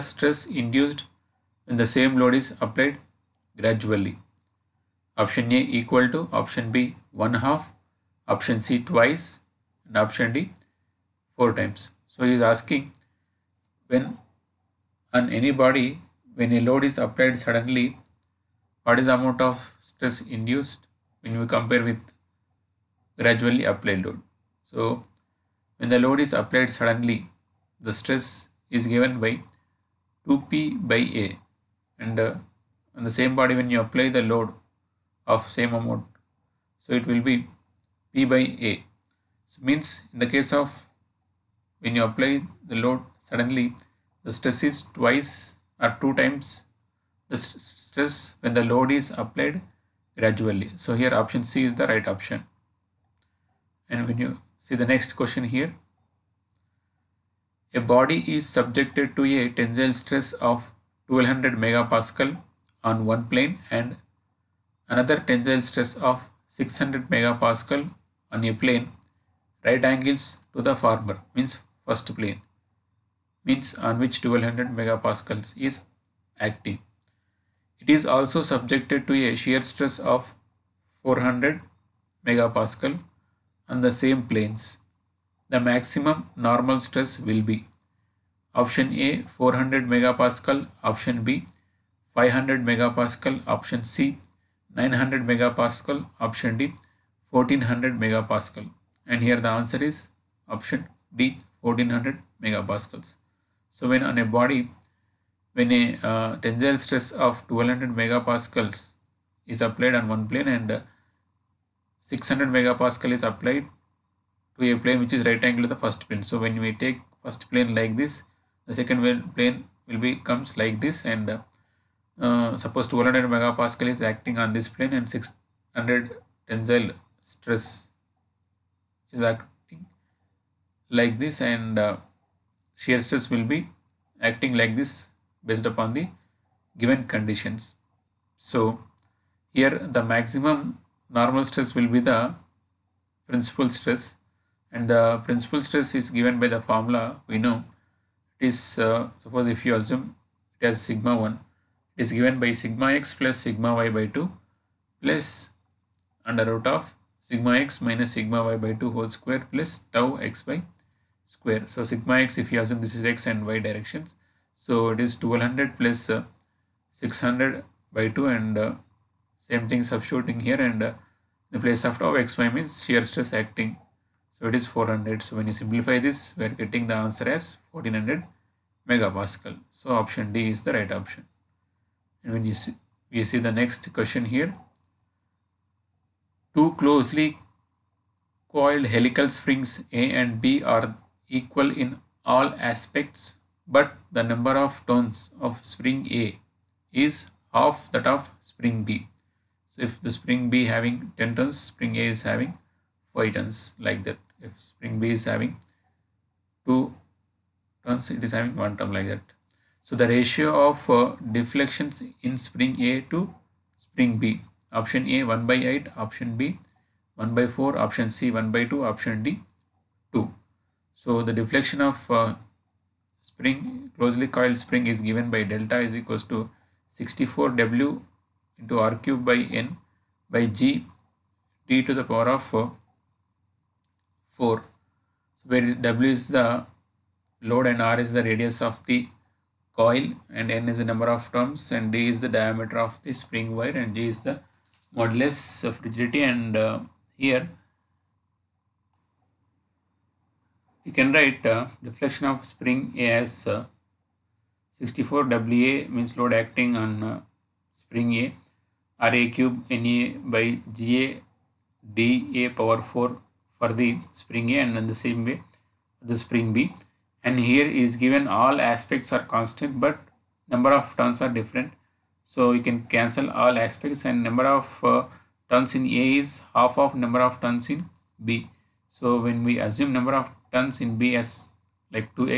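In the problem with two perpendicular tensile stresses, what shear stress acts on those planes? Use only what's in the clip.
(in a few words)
400 MPa.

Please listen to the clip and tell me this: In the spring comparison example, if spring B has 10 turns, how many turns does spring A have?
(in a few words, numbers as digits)
5.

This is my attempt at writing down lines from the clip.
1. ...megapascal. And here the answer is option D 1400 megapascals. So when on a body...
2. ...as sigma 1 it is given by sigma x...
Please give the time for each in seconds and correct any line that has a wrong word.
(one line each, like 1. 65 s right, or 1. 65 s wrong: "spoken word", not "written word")
1. 97 s right
2. 150 s right.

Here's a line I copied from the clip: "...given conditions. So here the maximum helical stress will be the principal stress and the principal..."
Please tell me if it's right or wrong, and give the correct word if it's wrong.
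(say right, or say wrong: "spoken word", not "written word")
wrong: "normal", not "helical".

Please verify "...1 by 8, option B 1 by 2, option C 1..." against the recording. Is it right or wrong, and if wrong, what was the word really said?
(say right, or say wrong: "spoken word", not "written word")
wrong: "4", not "2".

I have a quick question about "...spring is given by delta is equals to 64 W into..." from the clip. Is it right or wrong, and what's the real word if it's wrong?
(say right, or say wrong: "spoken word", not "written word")
right.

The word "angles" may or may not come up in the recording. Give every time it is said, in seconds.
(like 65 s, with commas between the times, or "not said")
69 s, 115 s.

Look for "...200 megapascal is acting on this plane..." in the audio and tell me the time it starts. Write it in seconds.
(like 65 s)
122 s.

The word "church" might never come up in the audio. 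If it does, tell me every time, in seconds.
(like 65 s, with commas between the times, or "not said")
not said.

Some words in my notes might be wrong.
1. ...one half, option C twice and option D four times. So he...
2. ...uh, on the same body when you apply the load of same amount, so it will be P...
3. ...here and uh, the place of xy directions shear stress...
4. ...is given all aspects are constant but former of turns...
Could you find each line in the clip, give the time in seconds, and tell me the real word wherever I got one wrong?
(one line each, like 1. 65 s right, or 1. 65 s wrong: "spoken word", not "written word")
1. 7 s right
2. 32 s right
3. 170 s wrong: "means", not "directions"
4. 267 s wrong: "number", not "former".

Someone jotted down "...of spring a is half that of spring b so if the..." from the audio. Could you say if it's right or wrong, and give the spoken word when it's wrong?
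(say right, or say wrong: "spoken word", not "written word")
right.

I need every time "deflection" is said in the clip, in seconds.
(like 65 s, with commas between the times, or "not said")
211 s, 221 s, 251 s.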